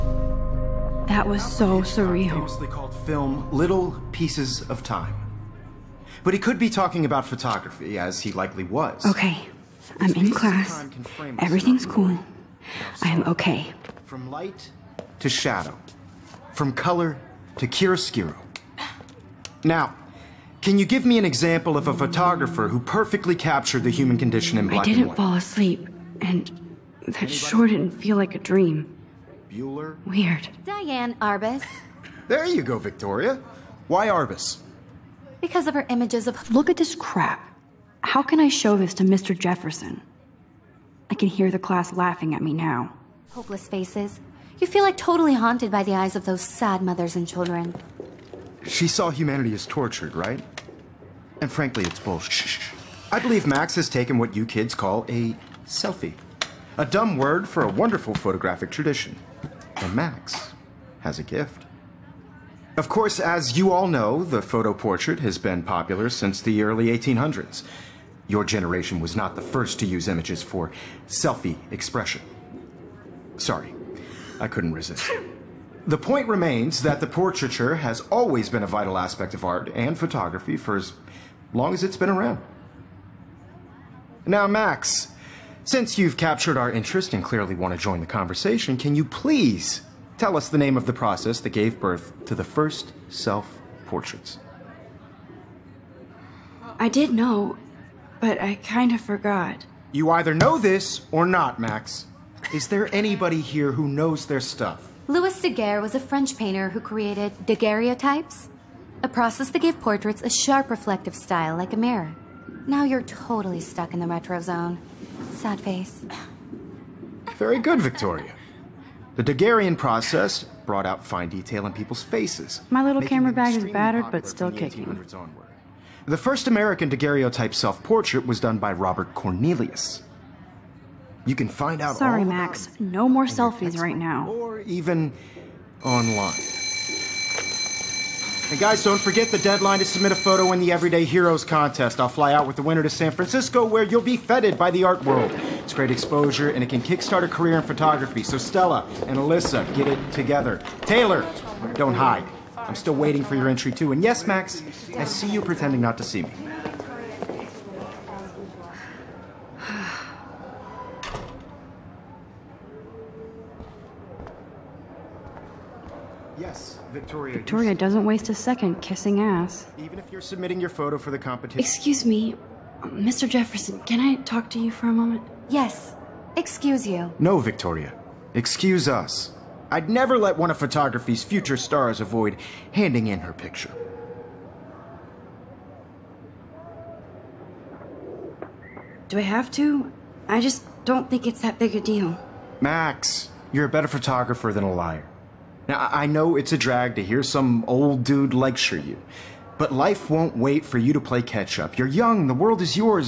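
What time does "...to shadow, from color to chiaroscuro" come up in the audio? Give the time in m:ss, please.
0:15.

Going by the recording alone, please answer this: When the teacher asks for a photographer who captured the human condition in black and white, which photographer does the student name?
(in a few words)
Diane Arbus.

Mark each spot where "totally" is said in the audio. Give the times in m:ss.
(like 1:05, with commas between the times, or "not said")
0:44, 1:53.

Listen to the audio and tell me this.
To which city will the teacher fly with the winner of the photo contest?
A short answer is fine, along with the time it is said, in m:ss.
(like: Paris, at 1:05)
San Francisco, at 2:22.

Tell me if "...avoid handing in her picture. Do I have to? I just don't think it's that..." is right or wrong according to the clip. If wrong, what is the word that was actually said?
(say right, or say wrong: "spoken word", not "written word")
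right.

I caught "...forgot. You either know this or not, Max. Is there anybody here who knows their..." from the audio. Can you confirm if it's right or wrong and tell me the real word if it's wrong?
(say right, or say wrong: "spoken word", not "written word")
right.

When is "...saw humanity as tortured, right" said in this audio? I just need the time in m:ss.
0:48.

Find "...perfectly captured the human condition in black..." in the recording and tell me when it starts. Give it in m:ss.
0:22.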